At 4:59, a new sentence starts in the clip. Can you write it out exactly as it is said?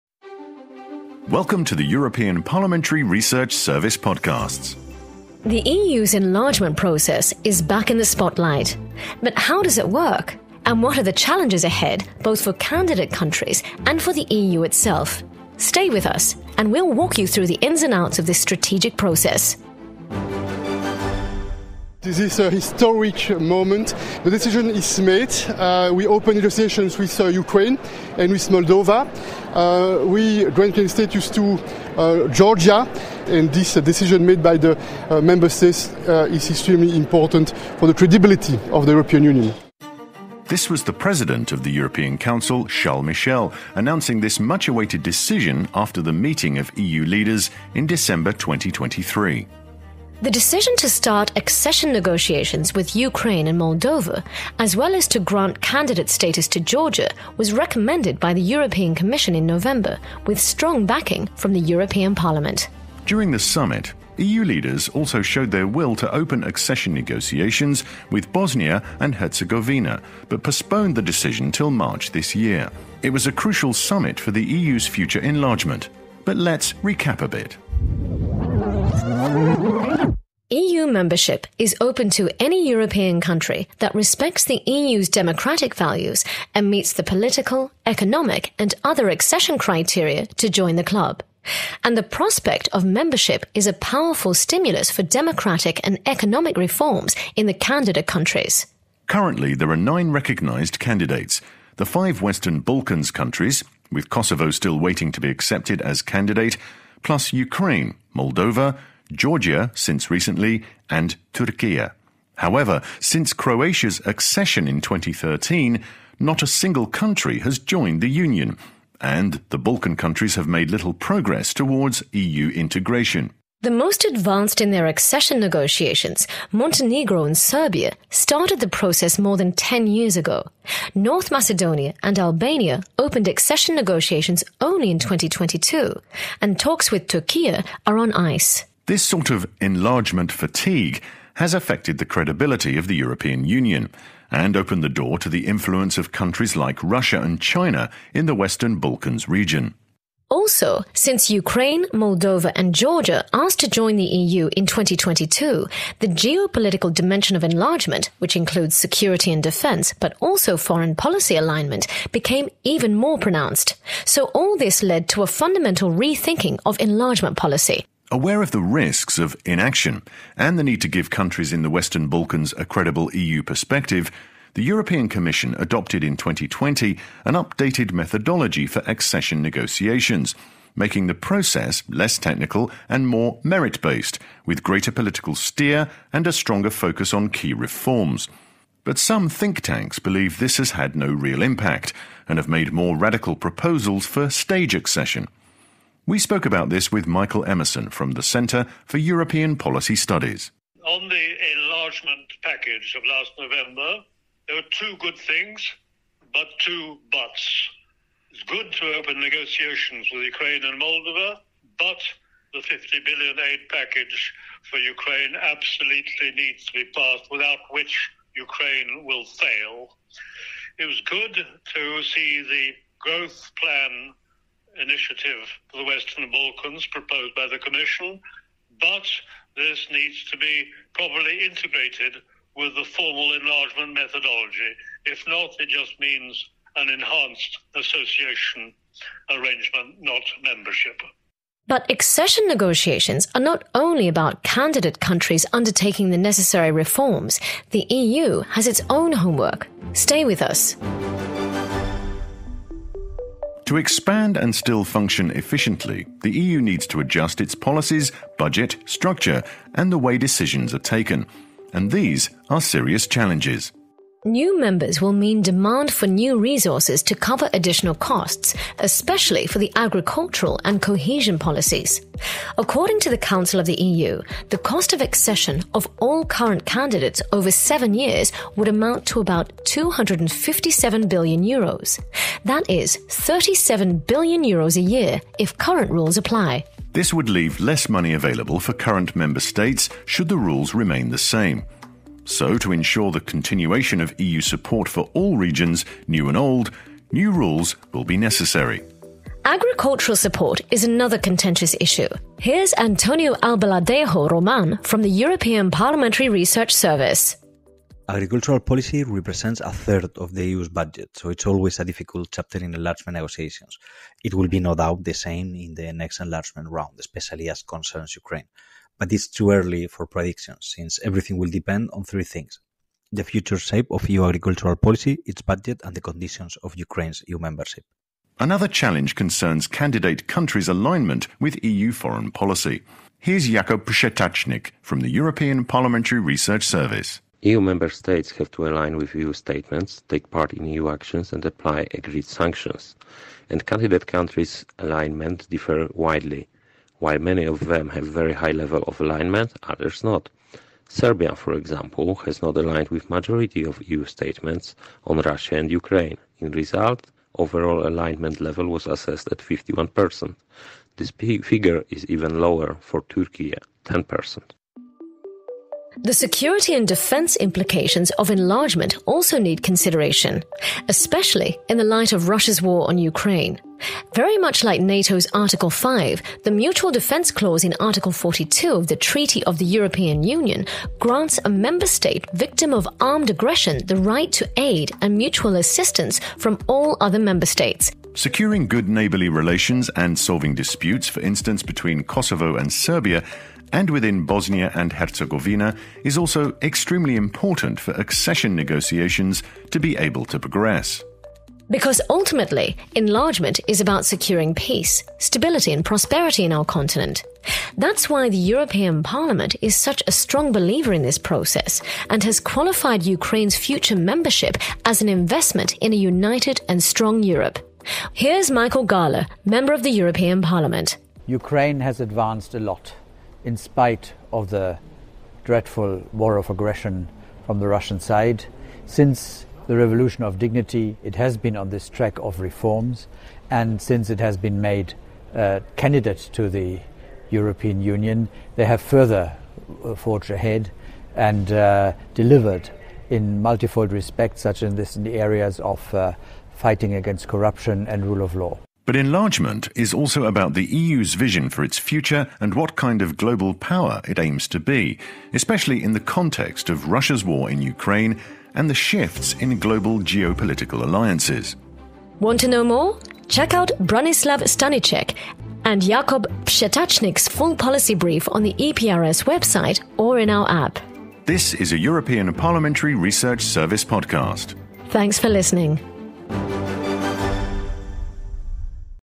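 Agricultural support is another contentious issue.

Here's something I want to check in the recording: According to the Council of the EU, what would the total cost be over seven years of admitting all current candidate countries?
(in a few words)
257 billion euros.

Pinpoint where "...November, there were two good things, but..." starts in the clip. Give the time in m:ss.
3:23.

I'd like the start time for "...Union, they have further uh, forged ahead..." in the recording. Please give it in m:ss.
7:17.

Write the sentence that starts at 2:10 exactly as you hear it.
North Macedonia and Albania opened accession negotiations only in 2022, and talks with Turkey are on ice.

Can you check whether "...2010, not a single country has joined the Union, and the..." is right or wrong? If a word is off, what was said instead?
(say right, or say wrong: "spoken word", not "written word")
wrong: "2013", not "2010".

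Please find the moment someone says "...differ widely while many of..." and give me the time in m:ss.
5:45.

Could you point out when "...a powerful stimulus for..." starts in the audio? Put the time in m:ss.
1:33.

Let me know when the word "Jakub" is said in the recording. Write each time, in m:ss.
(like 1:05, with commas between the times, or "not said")
5:33, 7:45.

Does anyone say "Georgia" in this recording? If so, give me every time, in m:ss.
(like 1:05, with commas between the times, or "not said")
0:32, 0:56, 1:49, 2:32.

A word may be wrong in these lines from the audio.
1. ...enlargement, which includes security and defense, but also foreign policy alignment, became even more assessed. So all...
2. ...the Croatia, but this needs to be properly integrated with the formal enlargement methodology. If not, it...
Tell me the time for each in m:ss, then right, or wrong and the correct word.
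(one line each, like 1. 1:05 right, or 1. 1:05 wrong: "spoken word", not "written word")
1. 2:37 wrong: "pronounced", not "assessed"
2. 3:47 wrong: "Commission", not "Croatia".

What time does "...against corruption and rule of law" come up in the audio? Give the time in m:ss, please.
7:26.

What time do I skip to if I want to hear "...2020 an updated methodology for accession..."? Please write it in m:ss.
2:56.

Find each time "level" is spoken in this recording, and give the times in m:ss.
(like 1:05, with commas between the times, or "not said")
5:48, 5:58.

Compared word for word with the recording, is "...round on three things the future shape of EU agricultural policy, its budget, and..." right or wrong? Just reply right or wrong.
wrong.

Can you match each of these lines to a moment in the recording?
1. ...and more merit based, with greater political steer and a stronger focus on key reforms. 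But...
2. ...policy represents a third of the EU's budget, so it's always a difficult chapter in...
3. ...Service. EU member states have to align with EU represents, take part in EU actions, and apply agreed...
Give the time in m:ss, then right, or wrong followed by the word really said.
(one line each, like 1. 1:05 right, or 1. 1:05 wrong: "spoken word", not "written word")
1. 3:02 right
2. 5:08 right
3. 5:36 wrong: "statements", not "represents".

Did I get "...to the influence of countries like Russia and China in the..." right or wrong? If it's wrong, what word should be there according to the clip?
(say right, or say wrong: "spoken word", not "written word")
right.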